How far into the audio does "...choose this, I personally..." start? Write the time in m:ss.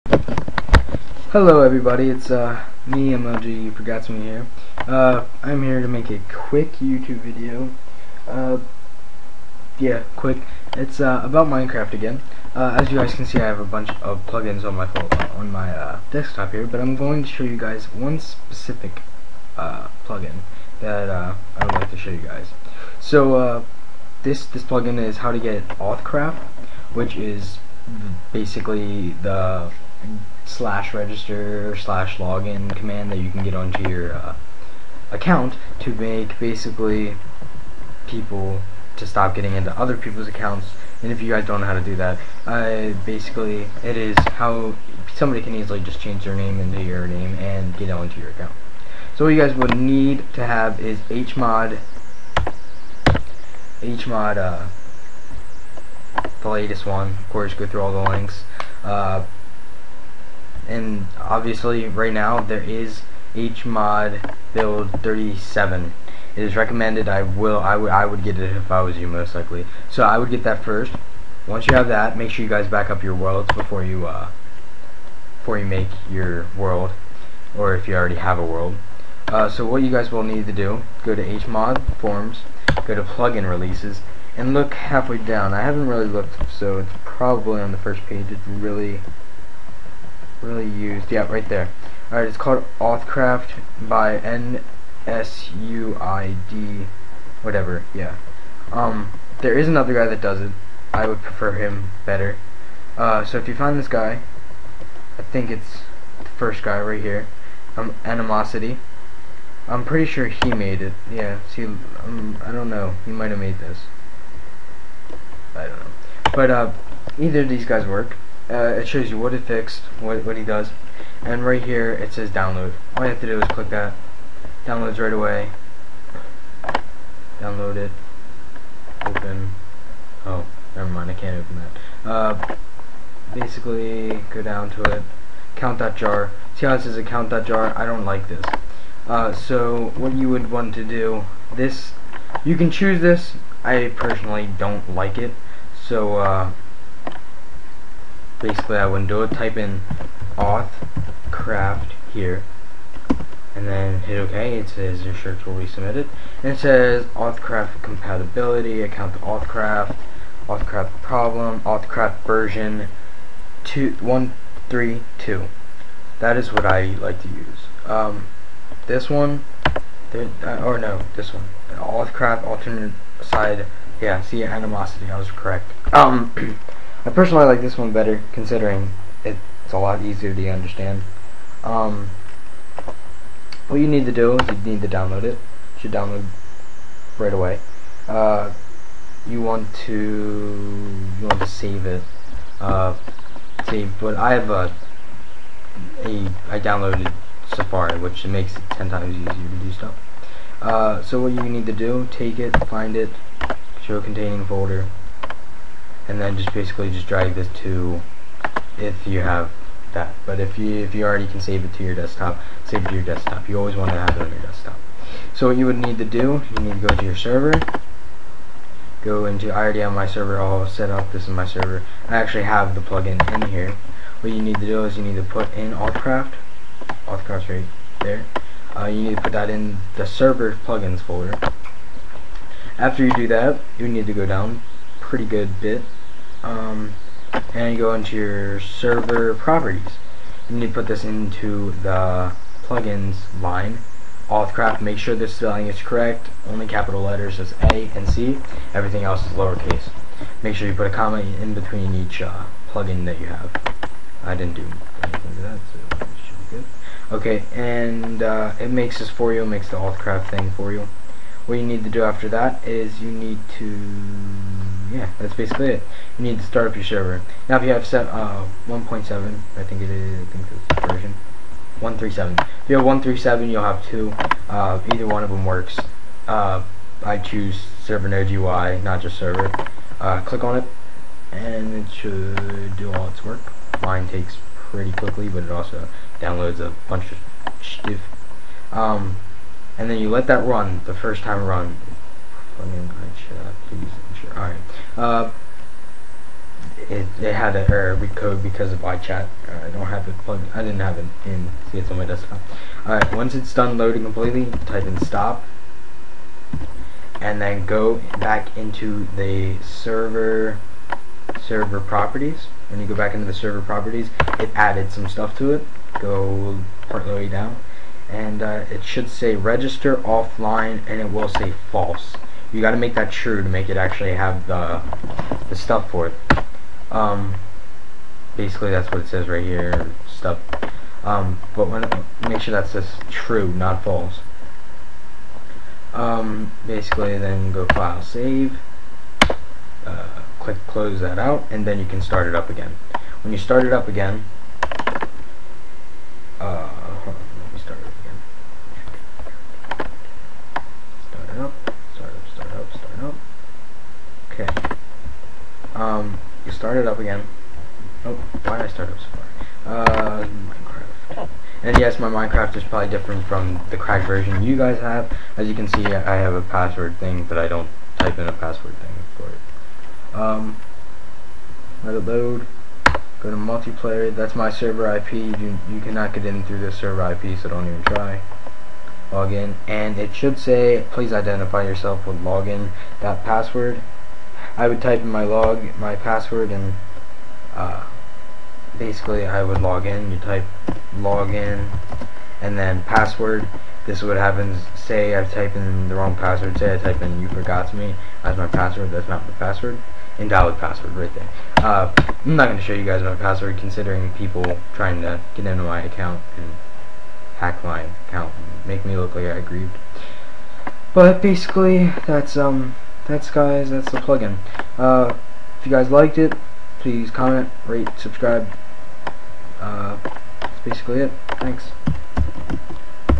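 2:22.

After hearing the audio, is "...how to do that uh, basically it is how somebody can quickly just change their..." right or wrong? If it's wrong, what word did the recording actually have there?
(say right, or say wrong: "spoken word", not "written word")
wrong: "easily", not "quickly".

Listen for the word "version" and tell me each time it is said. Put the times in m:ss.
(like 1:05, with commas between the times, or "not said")
2:42, 4:30, 6:04.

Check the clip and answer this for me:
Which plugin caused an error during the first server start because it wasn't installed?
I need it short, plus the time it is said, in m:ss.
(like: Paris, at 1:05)
iChat, at 4:58.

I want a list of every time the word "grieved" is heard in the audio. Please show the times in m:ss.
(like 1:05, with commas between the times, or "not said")
6:49.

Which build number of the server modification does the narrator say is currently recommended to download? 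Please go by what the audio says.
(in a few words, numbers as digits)
37.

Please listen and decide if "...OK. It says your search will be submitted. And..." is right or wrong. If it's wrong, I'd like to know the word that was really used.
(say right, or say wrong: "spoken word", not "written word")
right.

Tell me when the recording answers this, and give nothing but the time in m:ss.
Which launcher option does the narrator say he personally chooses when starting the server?
4:37.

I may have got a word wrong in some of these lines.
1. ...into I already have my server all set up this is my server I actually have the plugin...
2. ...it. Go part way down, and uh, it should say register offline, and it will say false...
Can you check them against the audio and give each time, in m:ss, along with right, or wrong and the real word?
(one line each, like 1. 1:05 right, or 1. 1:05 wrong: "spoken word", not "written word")
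1. 3:39 right
2. 5:15 right.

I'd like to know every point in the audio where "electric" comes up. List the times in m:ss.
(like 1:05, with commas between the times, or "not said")
not said.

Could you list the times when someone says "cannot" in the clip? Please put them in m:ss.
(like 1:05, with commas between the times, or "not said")
6:15.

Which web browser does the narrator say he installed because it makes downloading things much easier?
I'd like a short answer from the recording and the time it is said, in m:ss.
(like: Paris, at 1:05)
Safari, at 3:17.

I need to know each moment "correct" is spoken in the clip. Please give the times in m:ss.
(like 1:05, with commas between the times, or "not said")
2:55, 4:05.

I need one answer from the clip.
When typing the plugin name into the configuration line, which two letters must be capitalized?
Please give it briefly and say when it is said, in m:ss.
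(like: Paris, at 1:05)
A and C, at 4:07.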